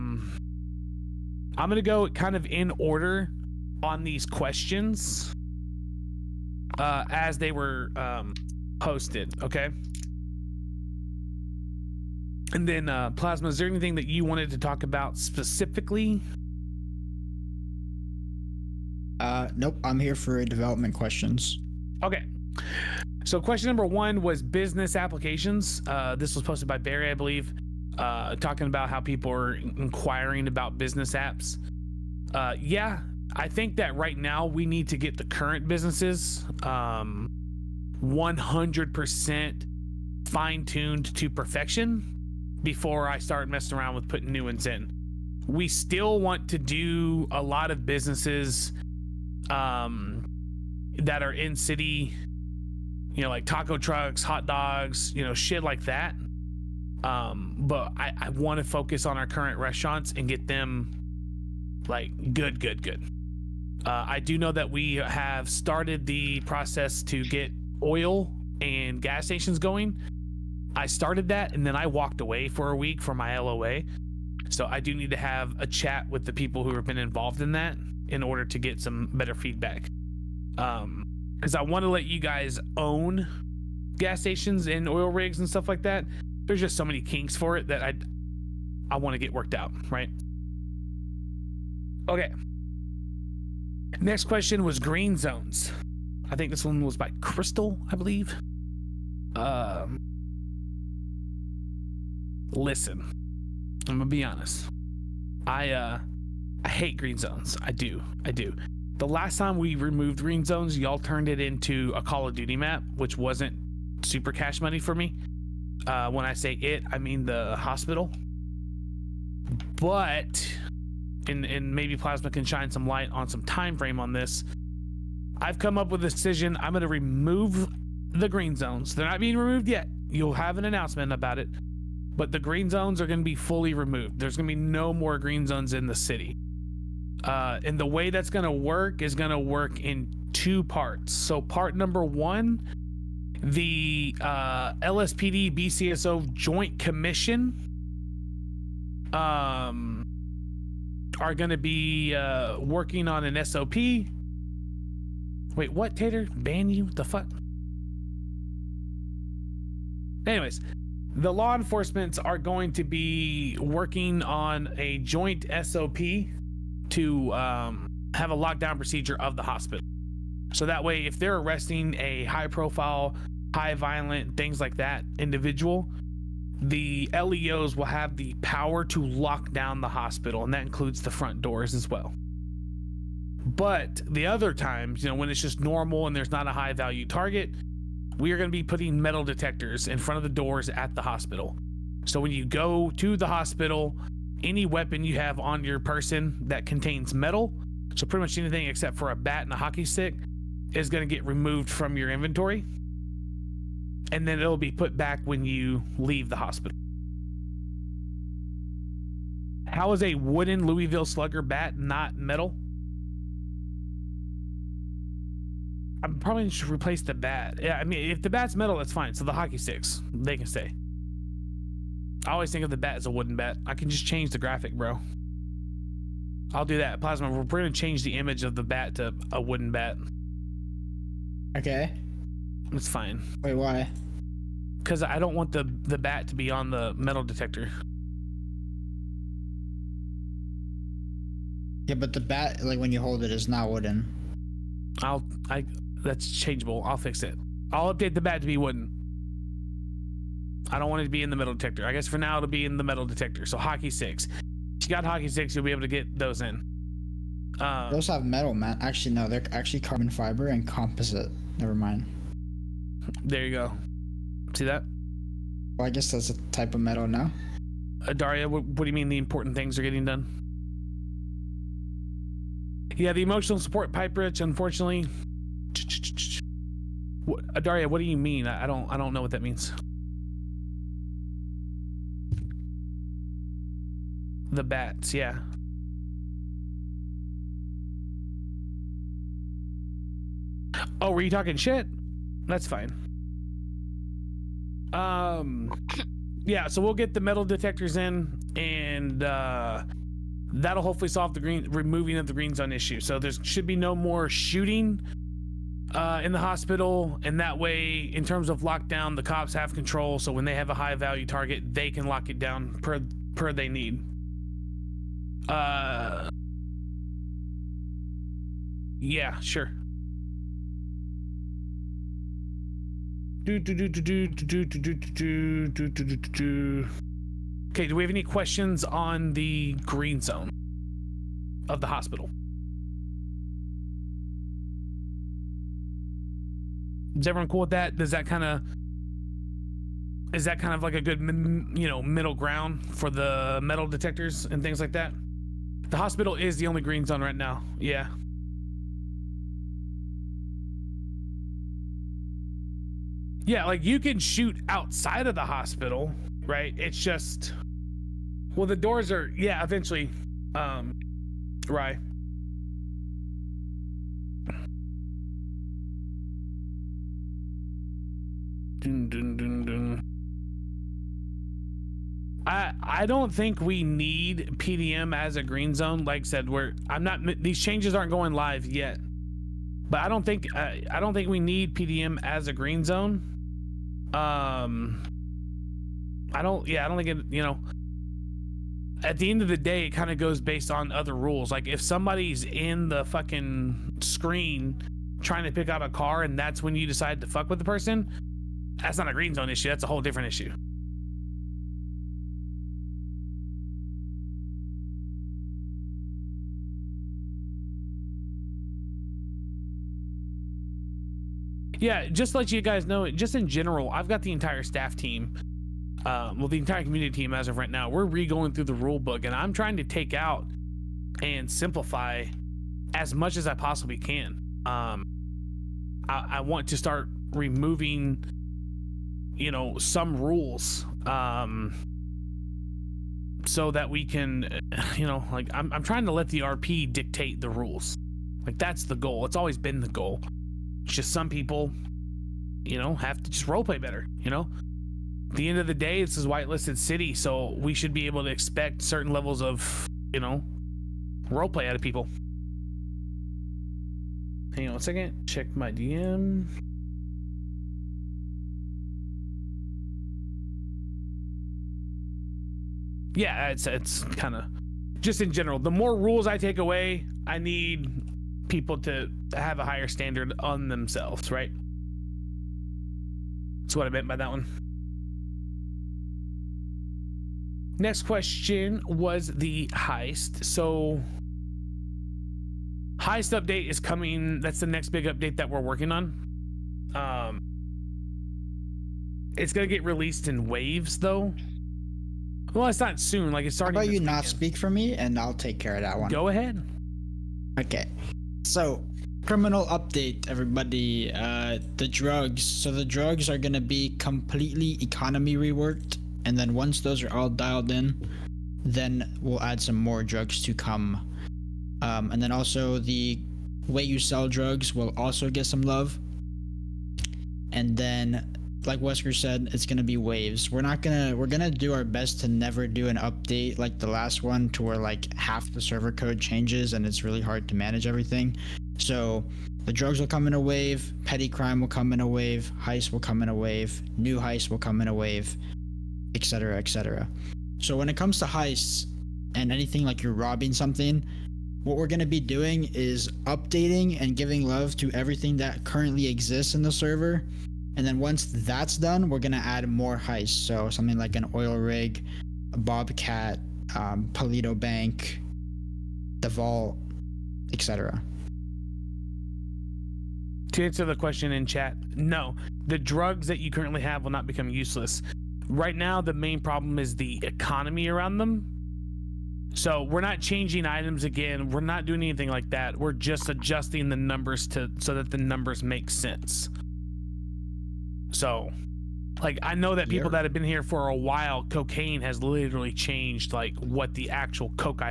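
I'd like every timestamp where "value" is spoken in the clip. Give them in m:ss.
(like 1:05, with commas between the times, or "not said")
3:06, 5:10.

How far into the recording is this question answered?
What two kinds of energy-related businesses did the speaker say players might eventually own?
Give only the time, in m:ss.
1:23.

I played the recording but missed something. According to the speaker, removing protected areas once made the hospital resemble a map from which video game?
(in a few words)
Call of Duty.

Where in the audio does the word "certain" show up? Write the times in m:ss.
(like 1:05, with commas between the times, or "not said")
7:28.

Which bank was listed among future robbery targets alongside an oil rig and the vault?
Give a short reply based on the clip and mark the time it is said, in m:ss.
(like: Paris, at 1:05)
Paleto Bank, at 9:14.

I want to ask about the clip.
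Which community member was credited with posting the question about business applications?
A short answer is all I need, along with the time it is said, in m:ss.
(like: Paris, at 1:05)
Barry, at 0:26.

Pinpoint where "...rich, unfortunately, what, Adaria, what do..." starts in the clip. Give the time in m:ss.
4:34.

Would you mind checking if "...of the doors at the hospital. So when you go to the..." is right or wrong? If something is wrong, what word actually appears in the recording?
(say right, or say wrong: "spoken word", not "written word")
right.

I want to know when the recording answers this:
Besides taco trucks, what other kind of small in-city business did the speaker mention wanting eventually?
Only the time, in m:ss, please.
0:54.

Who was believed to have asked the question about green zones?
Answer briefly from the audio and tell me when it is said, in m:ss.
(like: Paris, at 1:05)
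Crystal, at 1:37.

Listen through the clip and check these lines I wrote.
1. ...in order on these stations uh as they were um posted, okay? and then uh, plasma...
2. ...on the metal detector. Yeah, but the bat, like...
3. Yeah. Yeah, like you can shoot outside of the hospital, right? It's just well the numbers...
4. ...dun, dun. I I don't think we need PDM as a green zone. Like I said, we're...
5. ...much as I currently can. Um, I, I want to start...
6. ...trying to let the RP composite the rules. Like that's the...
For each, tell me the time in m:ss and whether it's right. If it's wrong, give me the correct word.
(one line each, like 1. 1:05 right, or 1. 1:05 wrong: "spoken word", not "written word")
1. 0:02 wrong: "questions", not "stations"
2. 3:56 right
3. 5:47 wrong: "doors", not "numbers"
4. 6:09 right
5. 7:03 wrong: "possibly", not "currently"
6. 7:15 wrong: "dictate", not "composite".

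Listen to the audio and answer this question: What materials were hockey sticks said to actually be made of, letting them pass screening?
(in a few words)
Carbon fiber and composite.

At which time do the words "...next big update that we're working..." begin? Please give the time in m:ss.
8:04.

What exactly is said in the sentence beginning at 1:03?
Uh, I do know that we have started the process to get oil and gas stations going.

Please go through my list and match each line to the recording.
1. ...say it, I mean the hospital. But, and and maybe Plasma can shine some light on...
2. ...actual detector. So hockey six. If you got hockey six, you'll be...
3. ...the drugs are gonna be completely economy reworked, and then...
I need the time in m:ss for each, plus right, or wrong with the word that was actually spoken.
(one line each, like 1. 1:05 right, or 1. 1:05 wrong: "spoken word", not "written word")
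1. 1:56 right
2. 4:12 wrong: "metal", not "actual"
3. 8:22 right.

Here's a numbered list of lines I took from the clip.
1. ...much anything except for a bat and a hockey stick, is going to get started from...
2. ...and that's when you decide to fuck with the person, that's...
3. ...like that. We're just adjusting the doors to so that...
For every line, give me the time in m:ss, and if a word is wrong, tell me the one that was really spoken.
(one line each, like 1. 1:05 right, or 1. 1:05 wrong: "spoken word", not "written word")
1. 3:18 wrong: "removed", not "started"
2. 6:36 right
3. 9:32 wrong: "numbers", not "doors".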